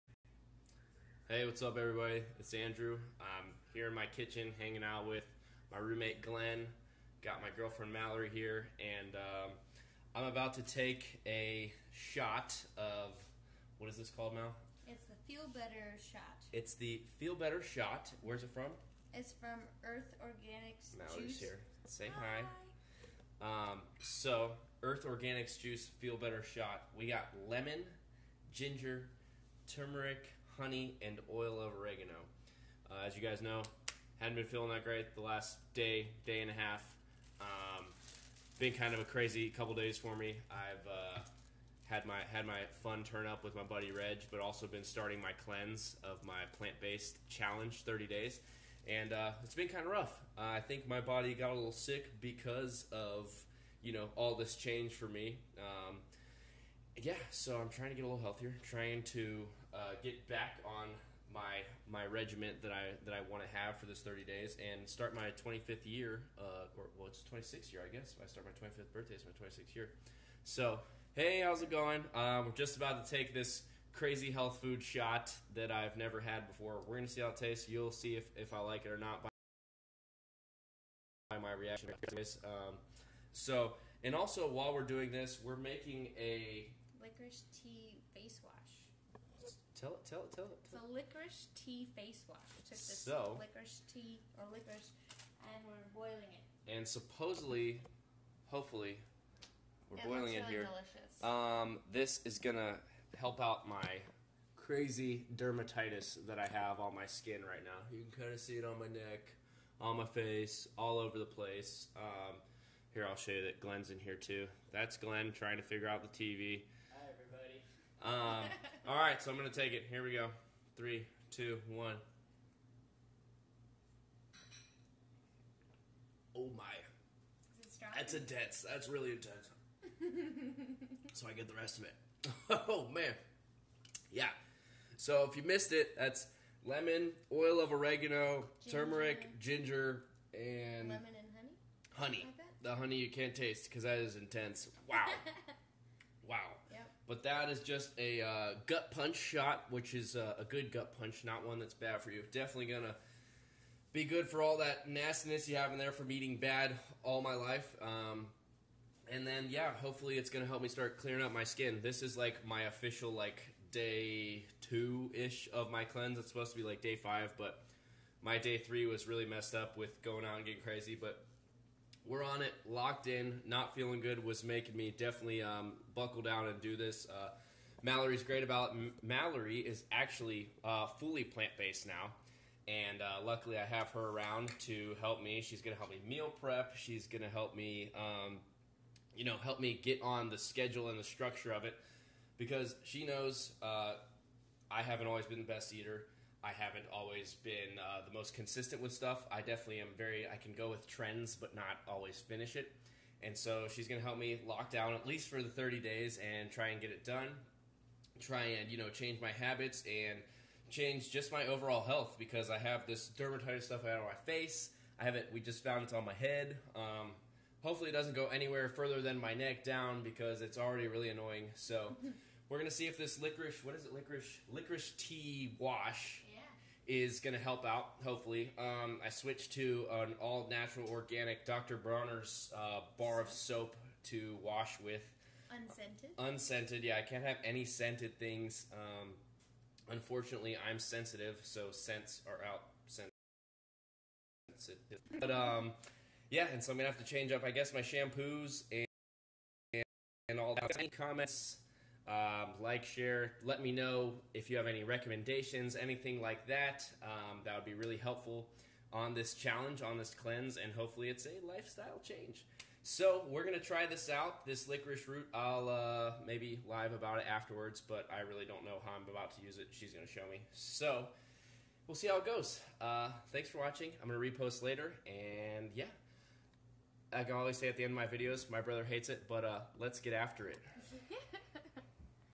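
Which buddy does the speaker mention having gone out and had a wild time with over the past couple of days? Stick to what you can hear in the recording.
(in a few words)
Reg.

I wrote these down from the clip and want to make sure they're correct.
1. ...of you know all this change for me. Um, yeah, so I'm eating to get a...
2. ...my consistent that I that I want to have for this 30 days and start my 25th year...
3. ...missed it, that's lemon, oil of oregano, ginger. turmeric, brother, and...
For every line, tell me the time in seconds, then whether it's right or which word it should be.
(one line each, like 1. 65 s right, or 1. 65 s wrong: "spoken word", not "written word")
1. 52 s wrong: "trying", not "eating"
2. 61 s wrong: "regiment", not "consistent"
3. 135 s wrong: "ginger", not "brother".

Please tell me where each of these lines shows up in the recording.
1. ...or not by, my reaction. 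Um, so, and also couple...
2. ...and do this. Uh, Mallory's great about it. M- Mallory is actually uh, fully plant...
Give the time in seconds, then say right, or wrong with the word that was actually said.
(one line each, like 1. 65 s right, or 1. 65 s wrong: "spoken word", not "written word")
1. 78 s wrong: "while", not "couple"
2. 176 s right.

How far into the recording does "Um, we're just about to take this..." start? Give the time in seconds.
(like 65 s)
72 s.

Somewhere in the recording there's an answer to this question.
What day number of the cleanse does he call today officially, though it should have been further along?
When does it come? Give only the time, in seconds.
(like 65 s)
163 s.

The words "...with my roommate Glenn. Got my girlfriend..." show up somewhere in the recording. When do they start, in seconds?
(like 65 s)
5 s.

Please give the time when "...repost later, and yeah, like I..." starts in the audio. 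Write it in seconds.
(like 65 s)
274 s.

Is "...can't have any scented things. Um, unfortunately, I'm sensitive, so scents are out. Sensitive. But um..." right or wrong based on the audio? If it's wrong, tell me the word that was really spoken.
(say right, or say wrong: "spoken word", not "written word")
right.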